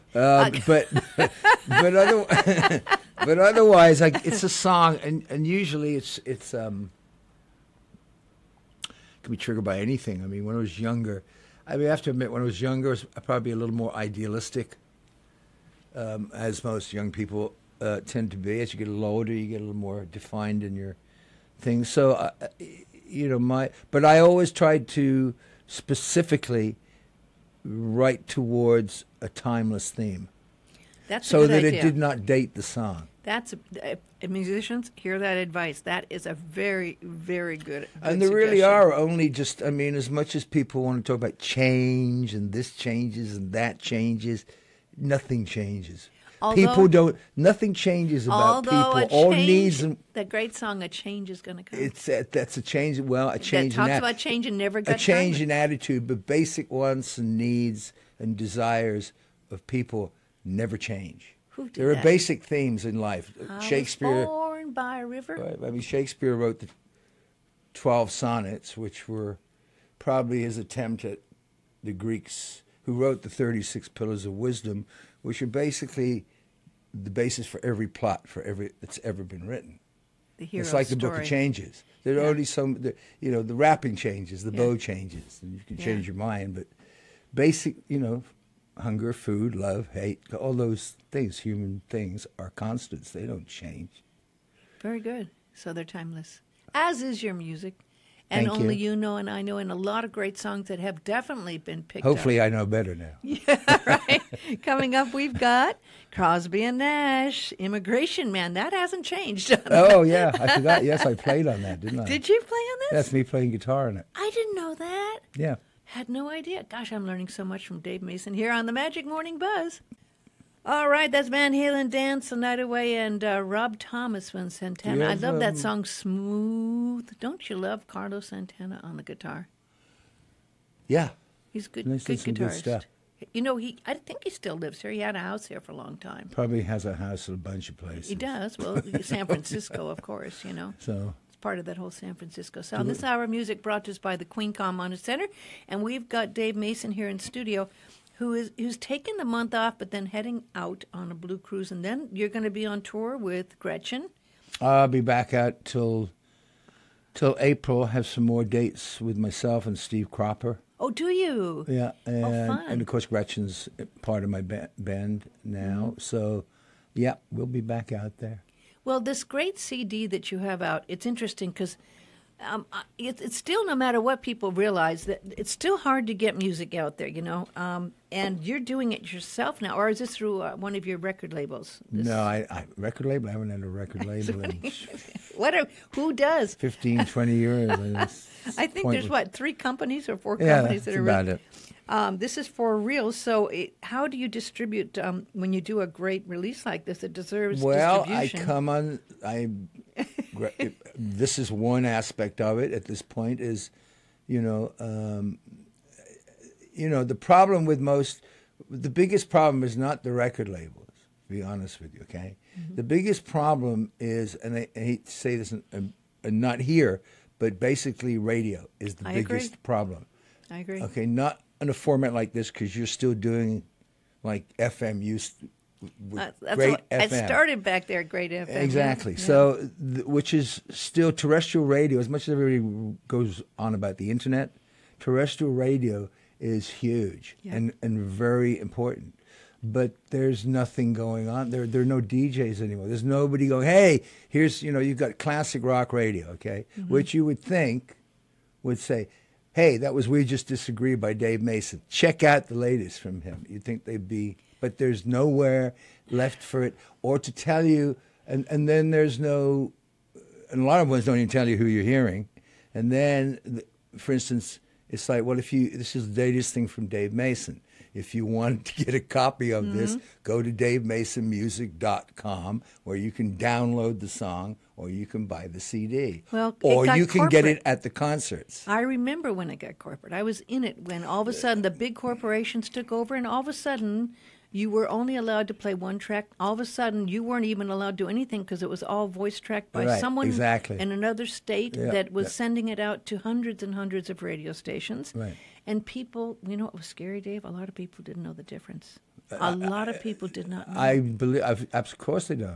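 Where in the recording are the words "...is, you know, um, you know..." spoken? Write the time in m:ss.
3:23.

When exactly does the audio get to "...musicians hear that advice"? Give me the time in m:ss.
0:34.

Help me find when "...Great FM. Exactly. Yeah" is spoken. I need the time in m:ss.
3:48.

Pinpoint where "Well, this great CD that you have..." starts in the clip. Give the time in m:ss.
2:48.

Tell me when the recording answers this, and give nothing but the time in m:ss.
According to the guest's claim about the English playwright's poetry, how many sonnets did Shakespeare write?
1:07.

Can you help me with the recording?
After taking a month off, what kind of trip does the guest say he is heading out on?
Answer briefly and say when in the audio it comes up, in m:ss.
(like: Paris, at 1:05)
a blue cruise, at 2:31.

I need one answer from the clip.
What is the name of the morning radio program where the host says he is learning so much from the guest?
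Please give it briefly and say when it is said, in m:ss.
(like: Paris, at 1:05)
Magic Morning Buzz, at 1:58.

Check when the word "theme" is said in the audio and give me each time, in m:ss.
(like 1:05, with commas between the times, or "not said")
0:29, 1:02.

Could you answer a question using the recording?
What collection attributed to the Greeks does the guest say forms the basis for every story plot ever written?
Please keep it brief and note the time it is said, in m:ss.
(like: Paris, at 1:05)
36 Pillars of Wisdom, at 1:13.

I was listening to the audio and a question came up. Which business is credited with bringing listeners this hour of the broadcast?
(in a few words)
Queen Com Center.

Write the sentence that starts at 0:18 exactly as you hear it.
As you get a little older, you get a little more defined in your things.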